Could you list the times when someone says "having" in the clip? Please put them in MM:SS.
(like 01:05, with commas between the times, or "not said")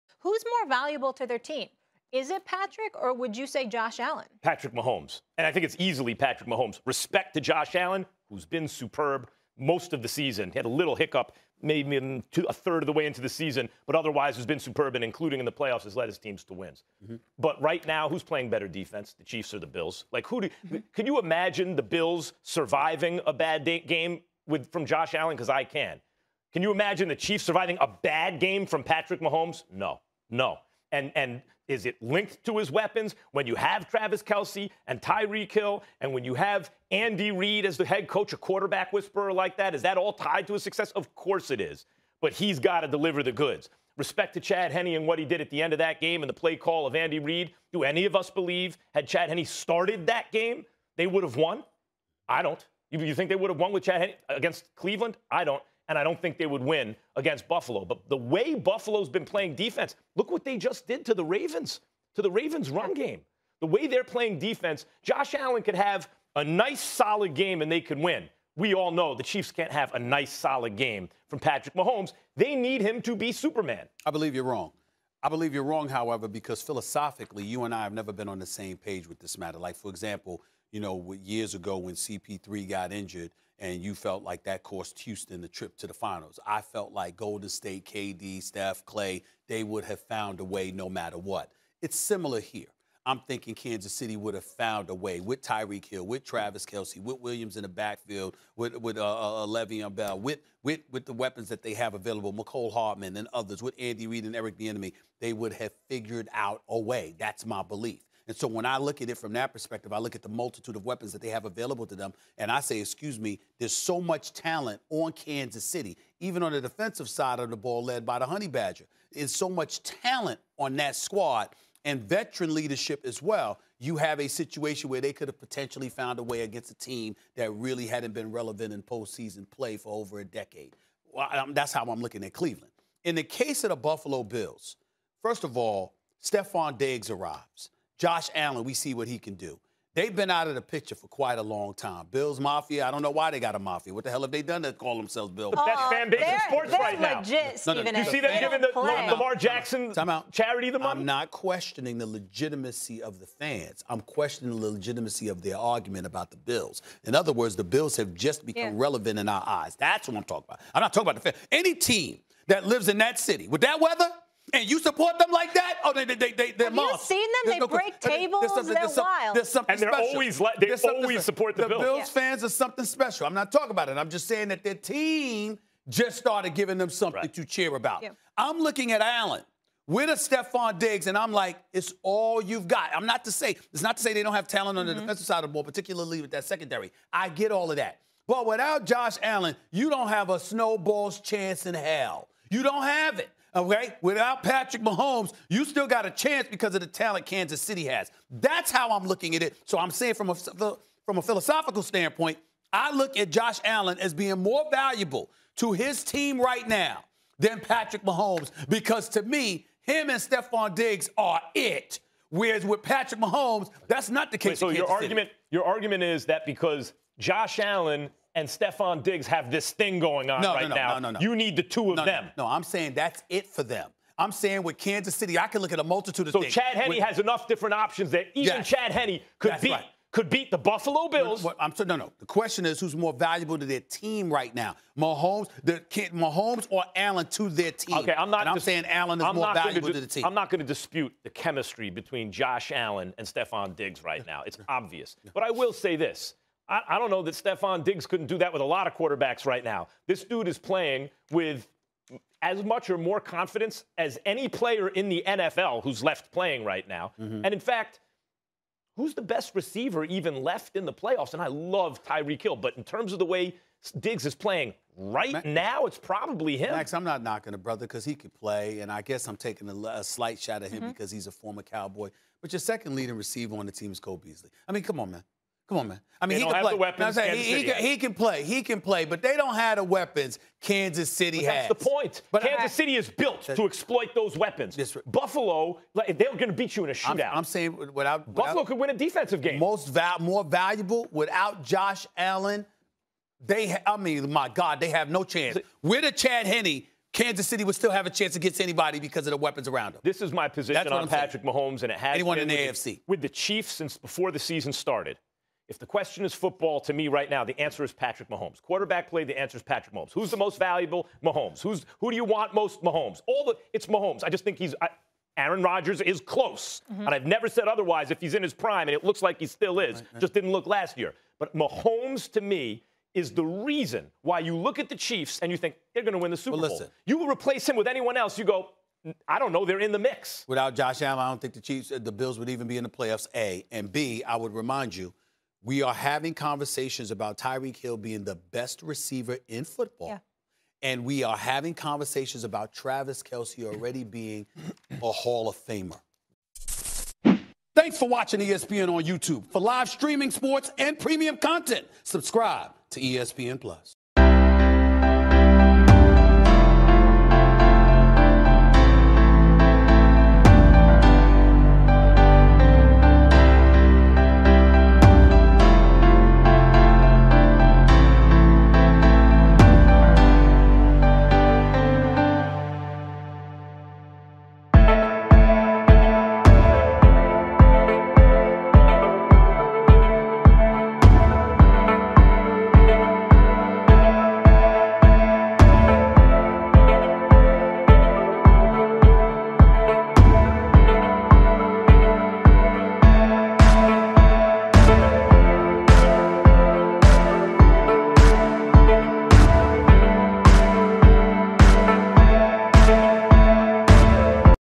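05:35, 05:41.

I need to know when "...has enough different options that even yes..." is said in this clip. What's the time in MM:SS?
03:46.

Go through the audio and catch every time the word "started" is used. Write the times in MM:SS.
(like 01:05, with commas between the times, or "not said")
00:49, 02:56, 05:04.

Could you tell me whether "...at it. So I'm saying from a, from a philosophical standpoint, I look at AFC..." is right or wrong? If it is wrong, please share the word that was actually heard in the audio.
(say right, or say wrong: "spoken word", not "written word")
wrong: "Josh", not "AFC".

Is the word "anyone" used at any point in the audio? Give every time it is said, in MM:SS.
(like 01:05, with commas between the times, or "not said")
05:02, 05:27.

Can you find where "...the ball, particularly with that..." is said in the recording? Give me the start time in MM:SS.
03:05.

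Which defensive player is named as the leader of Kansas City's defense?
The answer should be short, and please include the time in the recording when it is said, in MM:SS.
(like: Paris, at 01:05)
the Honey Badger, at 01:58.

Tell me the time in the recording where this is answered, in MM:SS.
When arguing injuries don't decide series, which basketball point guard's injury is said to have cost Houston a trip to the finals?
01:21.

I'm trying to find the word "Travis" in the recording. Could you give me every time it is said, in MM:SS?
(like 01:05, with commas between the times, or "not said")
00:33, 01:36, 05:42.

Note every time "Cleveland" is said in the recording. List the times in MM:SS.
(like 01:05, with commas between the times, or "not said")
00:54, 02:12.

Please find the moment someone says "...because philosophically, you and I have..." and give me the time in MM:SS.
01:16.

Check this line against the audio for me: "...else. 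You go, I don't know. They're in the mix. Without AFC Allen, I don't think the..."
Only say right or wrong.
wrong.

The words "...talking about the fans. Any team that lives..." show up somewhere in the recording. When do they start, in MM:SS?
02:40.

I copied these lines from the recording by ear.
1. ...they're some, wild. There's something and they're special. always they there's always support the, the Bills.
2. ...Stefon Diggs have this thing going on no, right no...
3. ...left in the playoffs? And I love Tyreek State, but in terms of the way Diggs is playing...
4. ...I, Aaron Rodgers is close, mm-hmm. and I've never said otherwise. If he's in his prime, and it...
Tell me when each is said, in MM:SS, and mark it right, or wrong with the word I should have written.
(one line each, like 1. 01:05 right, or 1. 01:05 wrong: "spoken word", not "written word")
1. 02:48 right
2. 03:38 right
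3. 04:20 wrong: "Hill", not "State"
4. 05:14 right.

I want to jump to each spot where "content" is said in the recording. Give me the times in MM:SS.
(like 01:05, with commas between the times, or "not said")
05:51.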